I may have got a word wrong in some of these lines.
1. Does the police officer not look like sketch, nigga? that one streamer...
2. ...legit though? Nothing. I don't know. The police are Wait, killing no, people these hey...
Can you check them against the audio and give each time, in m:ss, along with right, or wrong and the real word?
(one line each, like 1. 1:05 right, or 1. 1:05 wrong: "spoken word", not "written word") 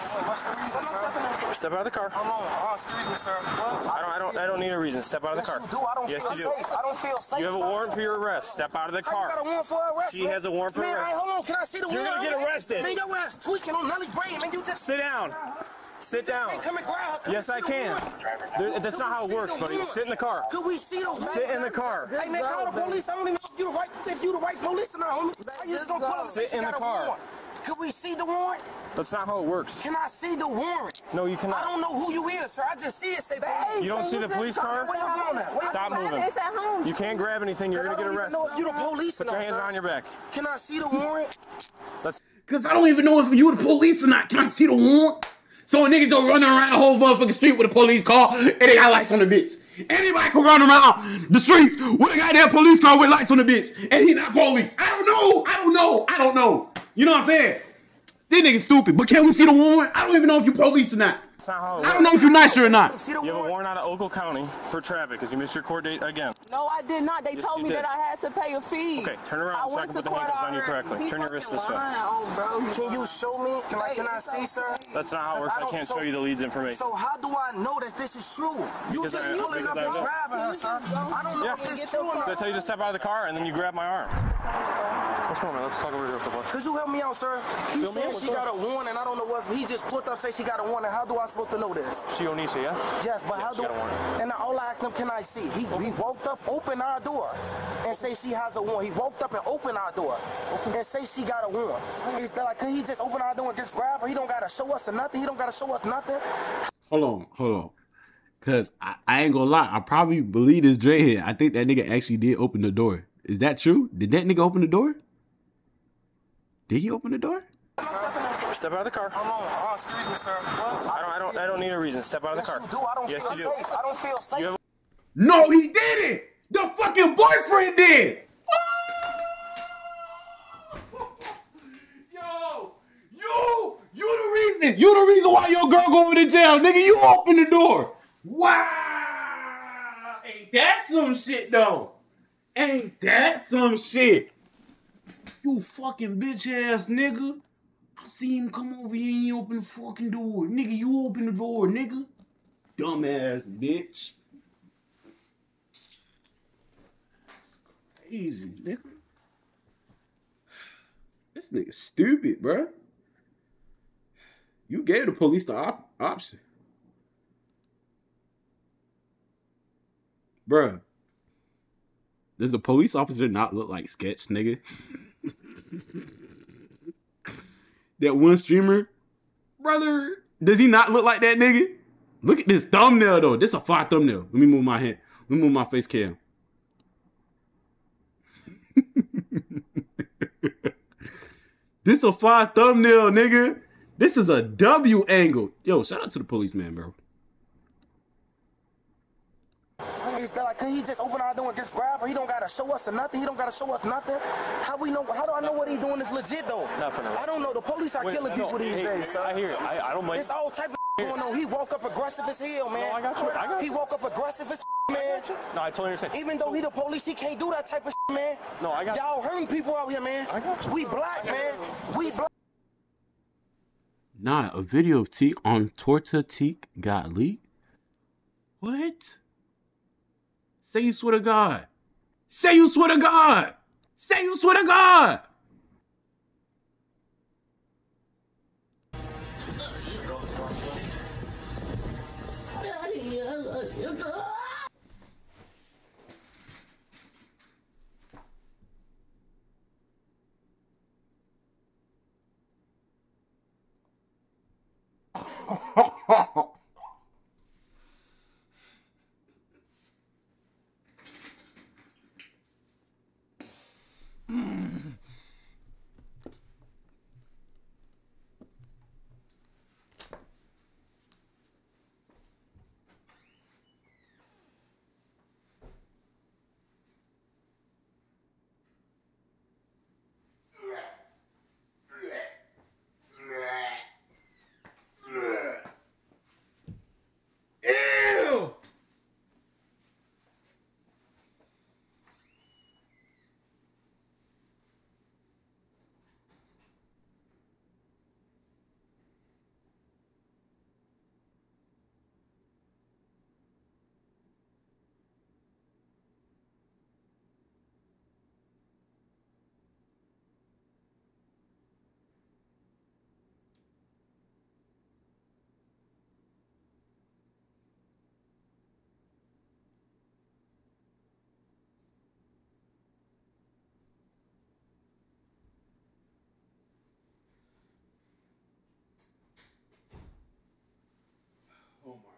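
1. 2:52 right
2. 3:26 right.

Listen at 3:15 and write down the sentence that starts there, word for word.
Yo, shout out to the policeman, bro.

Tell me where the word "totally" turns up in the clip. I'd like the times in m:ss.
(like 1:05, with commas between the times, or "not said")
3:35.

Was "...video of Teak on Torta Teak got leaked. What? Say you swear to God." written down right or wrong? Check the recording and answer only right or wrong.
right.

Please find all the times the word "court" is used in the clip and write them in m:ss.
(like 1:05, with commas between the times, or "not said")
1:05, 1:10.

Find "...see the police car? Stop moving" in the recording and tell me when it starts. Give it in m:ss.
0:34.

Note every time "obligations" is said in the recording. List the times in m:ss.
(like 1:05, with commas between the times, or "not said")
not said.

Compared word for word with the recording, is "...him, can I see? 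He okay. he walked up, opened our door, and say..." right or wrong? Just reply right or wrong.
right.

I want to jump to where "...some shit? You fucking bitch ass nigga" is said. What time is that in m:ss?
2:23.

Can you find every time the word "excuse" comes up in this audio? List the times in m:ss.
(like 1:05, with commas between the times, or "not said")
0:02, 1:59.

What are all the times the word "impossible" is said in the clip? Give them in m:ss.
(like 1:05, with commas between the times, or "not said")
not said.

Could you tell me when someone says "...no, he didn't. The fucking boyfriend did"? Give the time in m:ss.
2:05.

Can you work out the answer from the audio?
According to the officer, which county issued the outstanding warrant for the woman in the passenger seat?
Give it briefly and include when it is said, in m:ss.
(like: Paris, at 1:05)
Oakland County, at 1:03.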